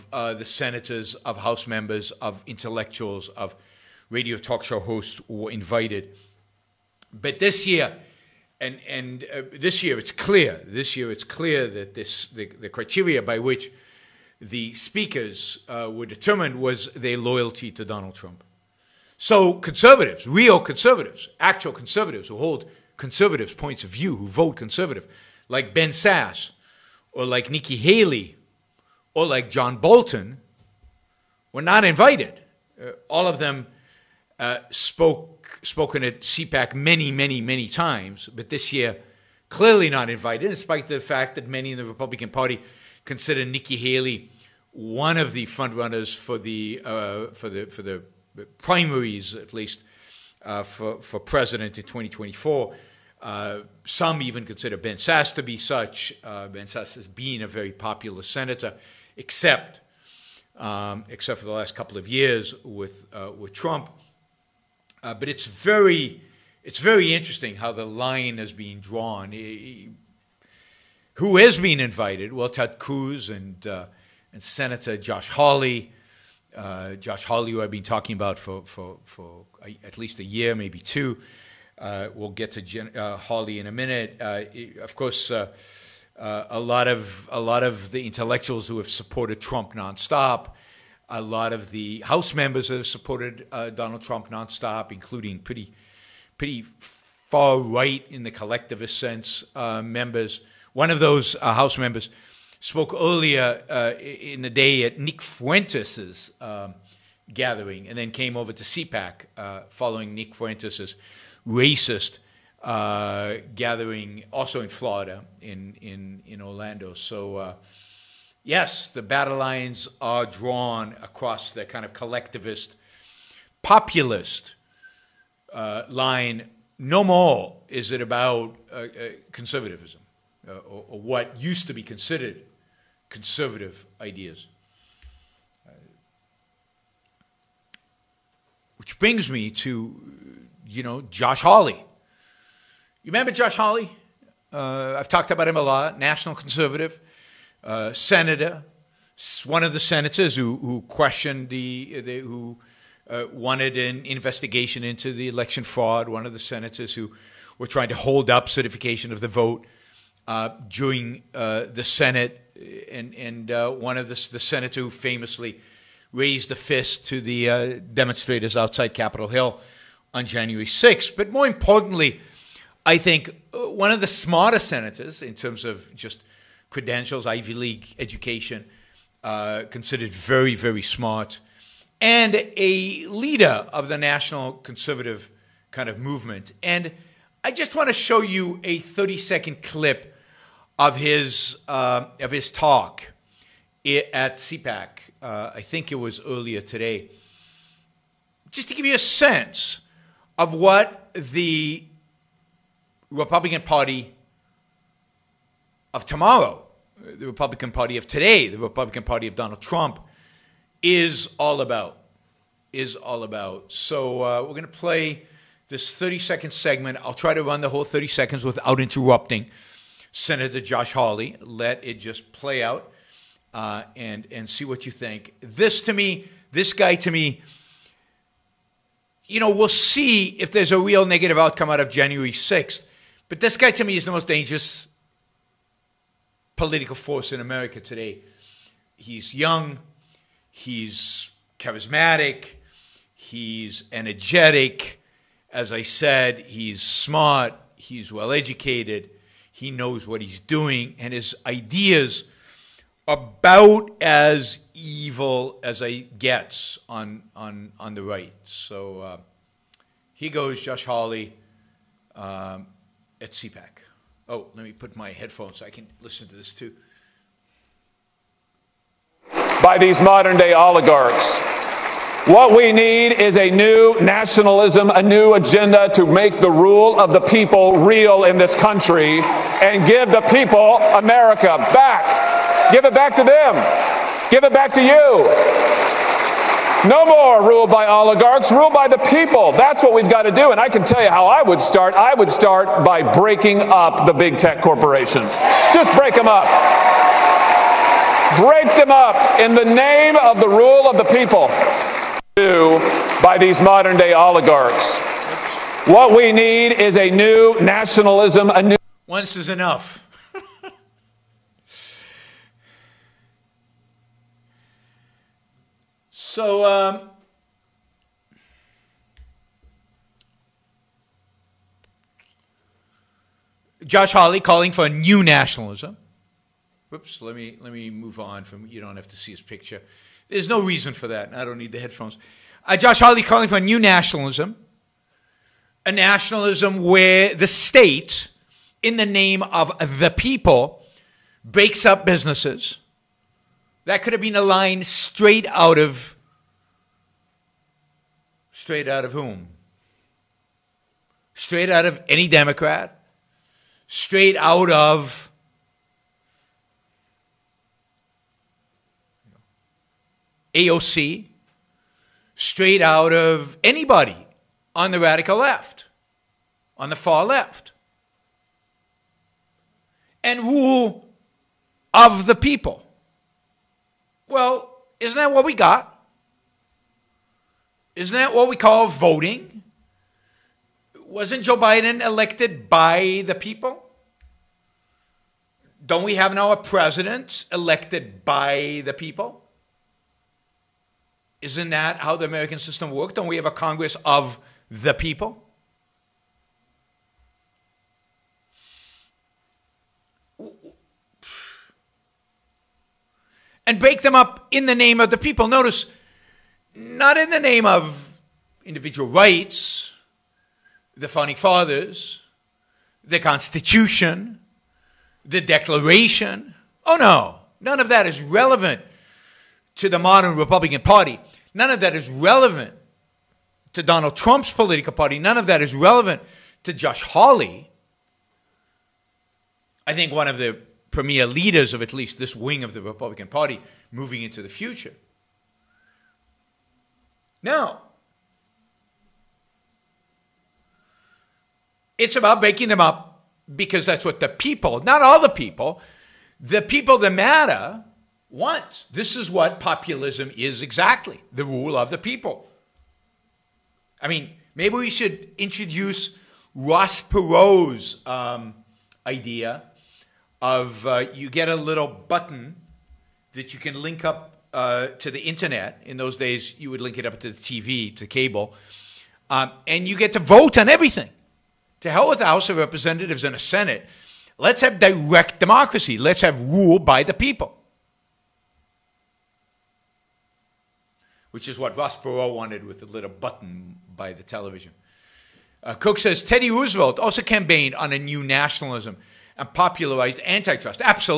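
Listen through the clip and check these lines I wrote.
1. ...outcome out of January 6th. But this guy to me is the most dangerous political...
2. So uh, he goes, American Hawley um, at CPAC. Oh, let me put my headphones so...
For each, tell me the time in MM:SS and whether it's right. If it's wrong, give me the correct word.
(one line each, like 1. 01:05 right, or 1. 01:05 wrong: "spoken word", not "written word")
1. 03:51 right
2. 04:18 wrong: "Josh", not "American".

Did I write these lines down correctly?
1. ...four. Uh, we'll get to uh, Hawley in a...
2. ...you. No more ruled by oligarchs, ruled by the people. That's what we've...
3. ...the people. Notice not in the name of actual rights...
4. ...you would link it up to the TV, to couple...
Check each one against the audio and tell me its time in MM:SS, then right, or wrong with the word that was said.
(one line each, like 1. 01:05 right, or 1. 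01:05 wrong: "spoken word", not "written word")
1. 01:20 wrong: "two", not "four"
2. 04:44 right
3. 06:45 wrong: "individual", not "actual"
4. 07:46 wrong: "cable", not "couple".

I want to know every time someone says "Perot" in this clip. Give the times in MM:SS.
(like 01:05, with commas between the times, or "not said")
07:37, 08:01.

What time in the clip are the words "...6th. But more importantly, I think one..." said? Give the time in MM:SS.
02:50.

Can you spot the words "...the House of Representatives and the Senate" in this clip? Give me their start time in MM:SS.
07:52.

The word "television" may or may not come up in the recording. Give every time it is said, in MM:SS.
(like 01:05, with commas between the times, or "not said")
08:04.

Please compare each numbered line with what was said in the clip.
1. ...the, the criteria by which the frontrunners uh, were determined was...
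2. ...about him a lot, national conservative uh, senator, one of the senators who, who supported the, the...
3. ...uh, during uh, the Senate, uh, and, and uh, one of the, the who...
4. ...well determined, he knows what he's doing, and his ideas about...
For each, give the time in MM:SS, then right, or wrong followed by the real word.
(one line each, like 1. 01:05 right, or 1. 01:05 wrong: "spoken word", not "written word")
1. 00:12 wrong: "speakers", not "frontrunners"
2. 02:25 wrong: "questioned", not "supported"
3. 02:40 right
4. 04:08 wrong: "educated", not "determined".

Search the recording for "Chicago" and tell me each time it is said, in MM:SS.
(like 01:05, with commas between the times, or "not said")
not said.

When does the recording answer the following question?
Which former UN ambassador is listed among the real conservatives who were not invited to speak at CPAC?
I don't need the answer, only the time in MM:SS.
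00:29.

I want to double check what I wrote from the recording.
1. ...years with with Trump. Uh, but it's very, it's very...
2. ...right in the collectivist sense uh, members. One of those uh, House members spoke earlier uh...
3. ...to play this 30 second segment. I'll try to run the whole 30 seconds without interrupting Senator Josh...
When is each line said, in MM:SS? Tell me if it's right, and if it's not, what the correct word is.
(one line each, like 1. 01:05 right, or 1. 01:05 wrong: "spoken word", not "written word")
1. 01:02 right
2. 01:37 right
3. 03:34 right.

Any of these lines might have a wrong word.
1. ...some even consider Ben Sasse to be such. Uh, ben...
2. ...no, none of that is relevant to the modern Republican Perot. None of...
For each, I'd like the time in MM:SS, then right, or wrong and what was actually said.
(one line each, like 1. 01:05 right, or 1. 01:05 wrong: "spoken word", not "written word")
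1. 00:53 right
2. 06:56 wrong: "Party", not "Perot".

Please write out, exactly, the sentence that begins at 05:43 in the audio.
That could have been a line straight out of Straight out of whom?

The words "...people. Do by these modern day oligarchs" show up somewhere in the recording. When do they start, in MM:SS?
05:01.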